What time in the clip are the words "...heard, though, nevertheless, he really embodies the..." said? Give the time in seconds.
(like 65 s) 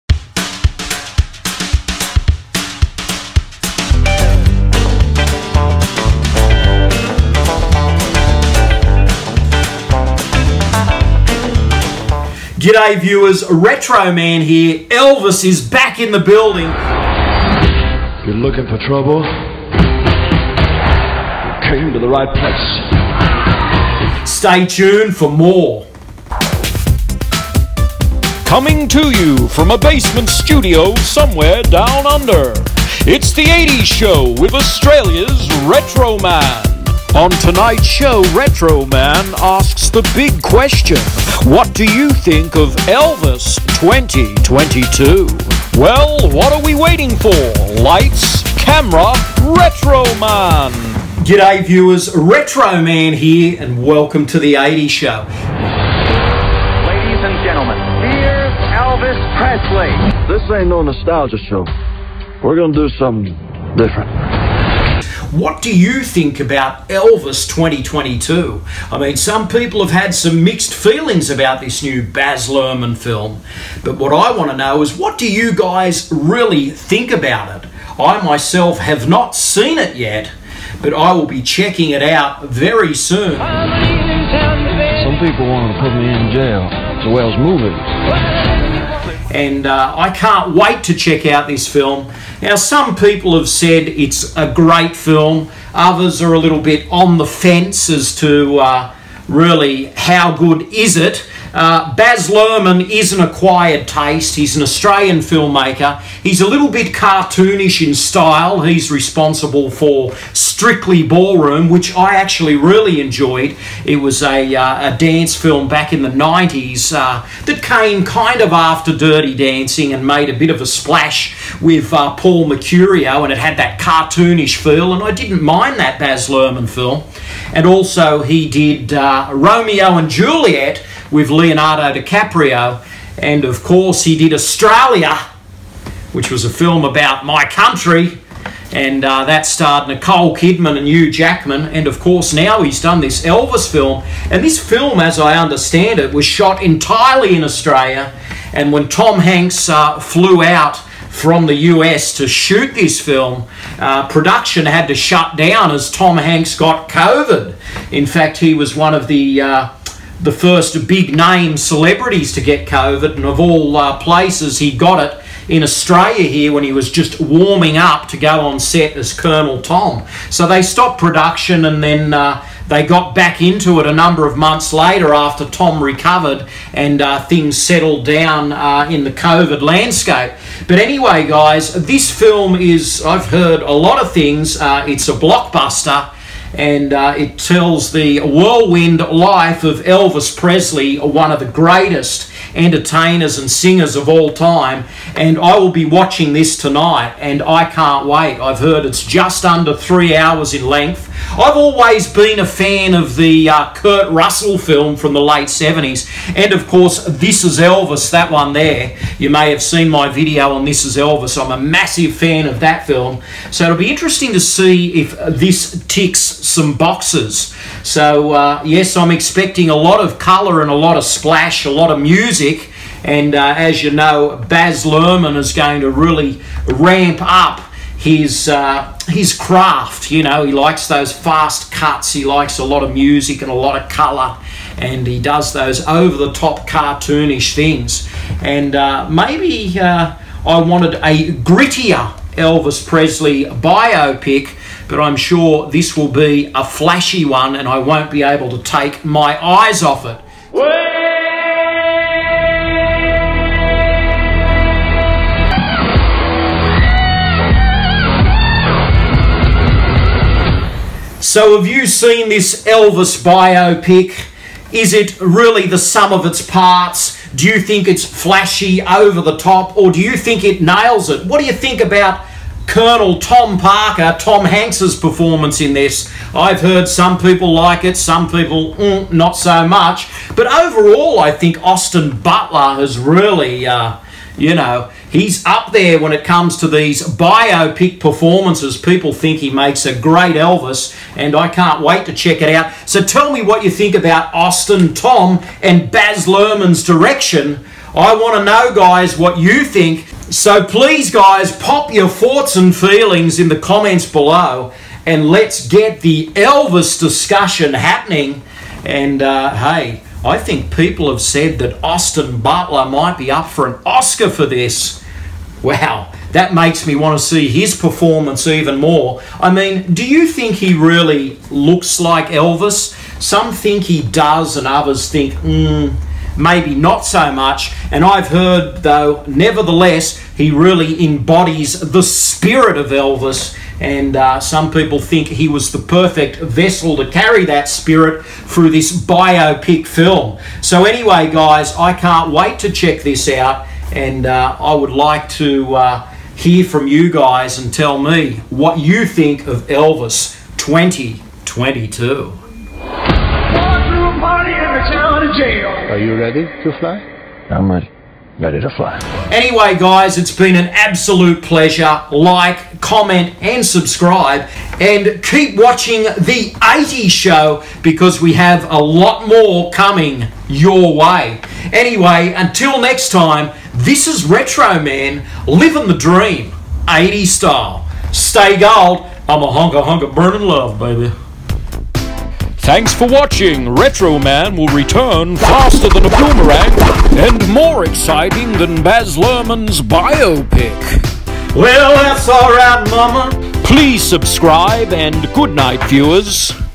328 s.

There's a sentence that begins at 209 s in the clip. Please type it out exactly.
You may have seen my video on This Is Elvis.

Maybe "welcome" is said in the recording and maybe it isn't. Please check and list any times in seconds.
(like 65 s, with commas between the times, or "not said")
53 s.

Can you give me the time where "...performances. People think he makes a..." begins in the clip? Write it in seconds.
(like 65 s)
287 s.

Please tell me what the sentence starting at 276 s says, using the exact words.
I've heard some people like it, some people mm, not so much.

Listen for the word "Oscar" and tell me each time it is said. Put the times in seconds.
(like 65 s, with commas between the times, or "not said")
313 s.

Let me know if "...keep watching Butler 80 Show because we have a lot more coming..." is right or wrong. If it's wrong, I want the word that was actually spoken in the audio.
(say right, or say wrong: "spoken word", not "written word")
wrong: "The", not "Butler".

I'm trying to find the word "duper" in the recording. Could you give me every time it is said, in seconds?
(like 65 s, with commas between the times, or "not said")
not said.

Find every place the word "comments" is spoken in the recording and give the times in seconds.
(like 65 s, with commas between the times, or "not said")
303 s, 362 s.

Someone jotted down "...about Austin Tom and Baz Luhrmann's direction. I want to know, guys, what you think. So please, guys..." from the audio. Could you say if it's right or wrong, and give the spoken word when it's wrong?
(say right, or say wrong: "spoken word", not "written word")
right.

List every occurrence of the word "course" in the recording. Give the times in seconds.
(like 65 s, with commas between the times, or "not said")
133 s, 141 s, 206 s.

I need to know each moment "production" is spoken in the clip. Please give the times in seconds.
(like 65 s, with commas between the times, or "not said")
154 s, 170 s.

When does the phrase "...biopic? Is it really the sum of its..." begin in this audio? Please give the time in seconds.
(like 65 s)
263 s.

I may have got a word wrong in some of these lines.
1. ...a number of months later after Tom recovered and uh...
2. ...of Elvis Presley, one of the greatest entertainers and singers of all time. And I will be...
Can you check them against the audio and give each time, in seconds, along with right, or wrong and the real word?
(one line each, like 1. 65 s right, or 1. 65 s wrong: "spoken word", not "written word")
1. 173 s right
2. 189 s right.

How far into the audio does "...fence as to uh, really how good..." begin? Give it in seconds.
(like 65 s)
97 s.